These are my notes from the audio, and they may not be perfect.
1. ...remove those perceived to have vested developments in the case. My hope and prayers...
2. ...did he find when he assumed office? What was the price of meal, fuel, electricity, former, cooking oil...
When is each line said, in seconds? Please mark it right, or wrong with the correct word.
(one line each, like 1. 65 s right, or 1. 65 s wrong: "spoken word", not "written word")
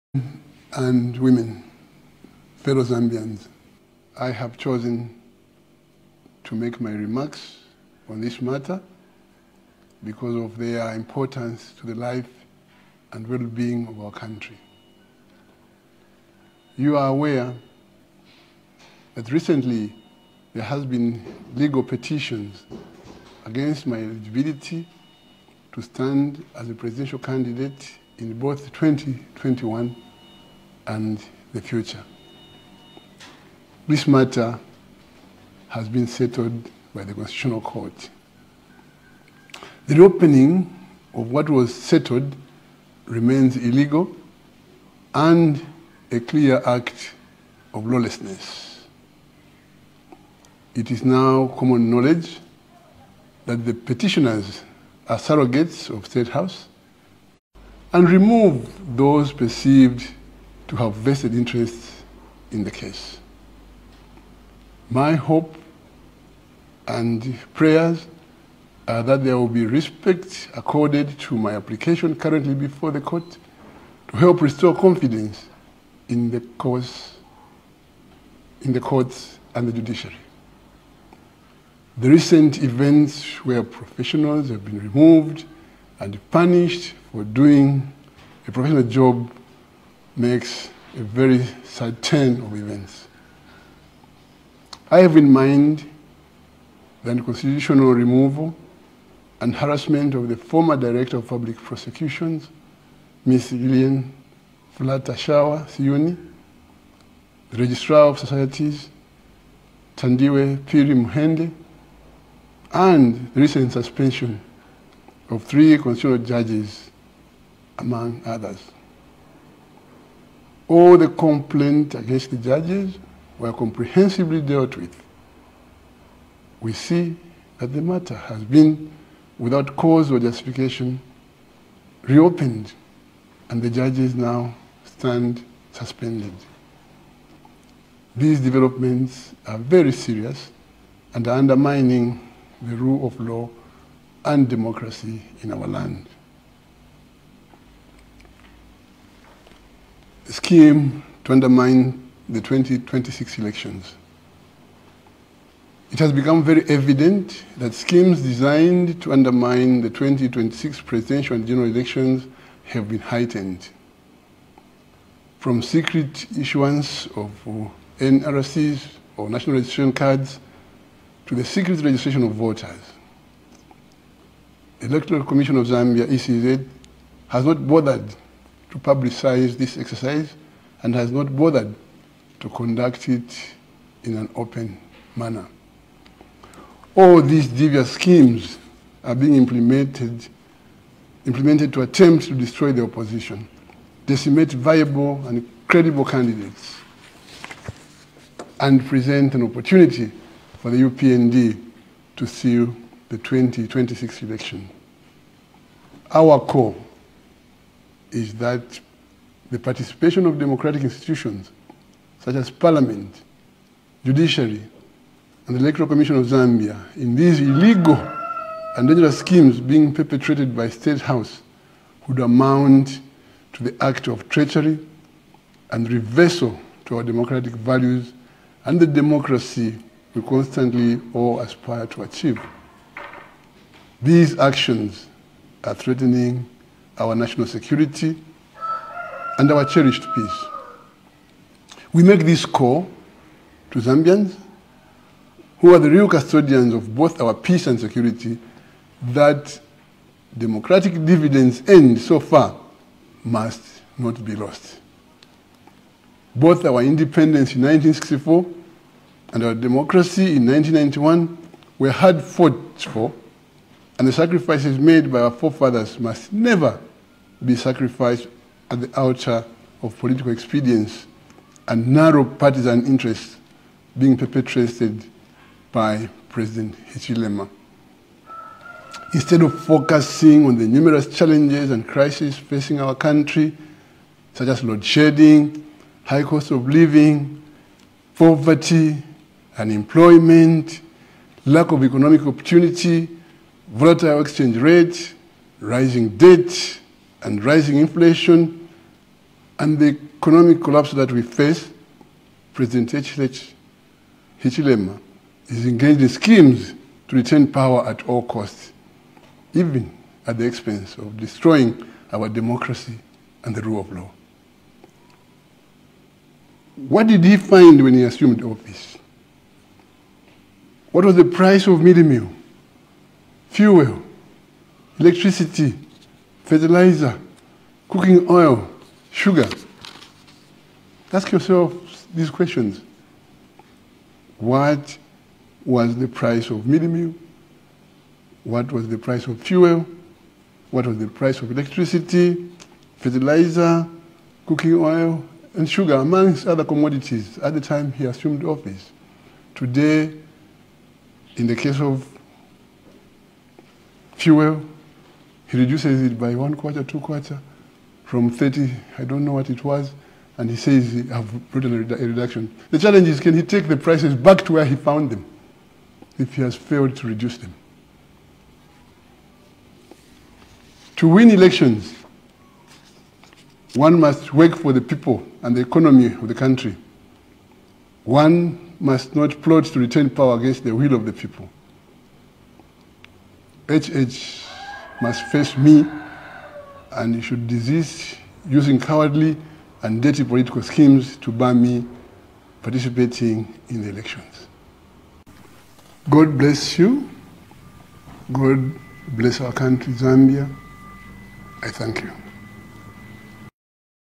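1. 58 s wrong: "interests", not "developments"
2. 317 s wrong: "fertilizer", not "former".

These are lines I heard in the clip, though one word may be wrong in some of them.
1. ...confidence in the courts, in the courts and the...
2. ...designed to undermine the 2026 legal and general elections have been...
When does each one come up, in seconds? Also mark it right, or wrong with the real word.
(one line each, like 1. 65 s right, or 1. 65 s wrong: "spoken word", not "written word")
1. 74 s right
2. 158 s wrong: "presidential", not "legal".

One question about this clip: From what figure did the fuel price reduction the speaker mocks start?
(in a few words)
30.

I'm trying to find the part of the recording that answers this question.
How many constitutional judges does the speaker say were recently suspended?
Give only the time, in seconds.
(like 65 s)
115 s.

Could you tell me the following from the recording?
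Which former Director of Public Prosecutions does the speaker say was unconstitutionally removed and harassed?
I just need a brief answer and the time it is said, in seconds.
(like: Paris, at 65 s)
Gillian Flatashawa Siyuni, at 103 s.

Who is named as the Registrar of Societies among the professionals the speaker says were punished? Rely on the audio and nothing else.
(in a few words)
Thandiwe Phiri Muhende.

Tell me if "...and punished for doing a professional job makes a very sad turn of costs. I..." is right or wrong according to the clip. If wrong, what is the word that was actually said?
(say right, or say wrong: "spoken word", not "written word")
wrong: "events", not "costs".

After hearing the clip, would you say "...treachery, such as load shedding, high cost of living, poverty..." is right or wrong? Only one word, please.
wrong.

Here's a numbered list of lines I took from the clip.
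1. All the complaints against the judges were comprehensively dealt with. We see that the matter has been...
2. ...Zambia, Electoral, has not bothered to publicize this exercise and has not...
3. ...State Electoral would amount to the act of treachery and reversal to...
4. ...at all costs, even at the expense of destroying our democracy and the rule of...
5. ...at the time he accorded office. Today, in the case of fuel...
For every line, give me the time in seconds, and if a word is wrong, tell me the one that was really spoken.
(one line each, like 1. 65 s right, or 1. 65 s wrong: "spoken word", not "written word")
1. 120 s right
2. 175 s wrong: "ECZ", not "Electoral"
3. 220 s wrong: "House", not "Electoral"
4. 307 s right
5. 347 s wrong: "assumed", not "accorded".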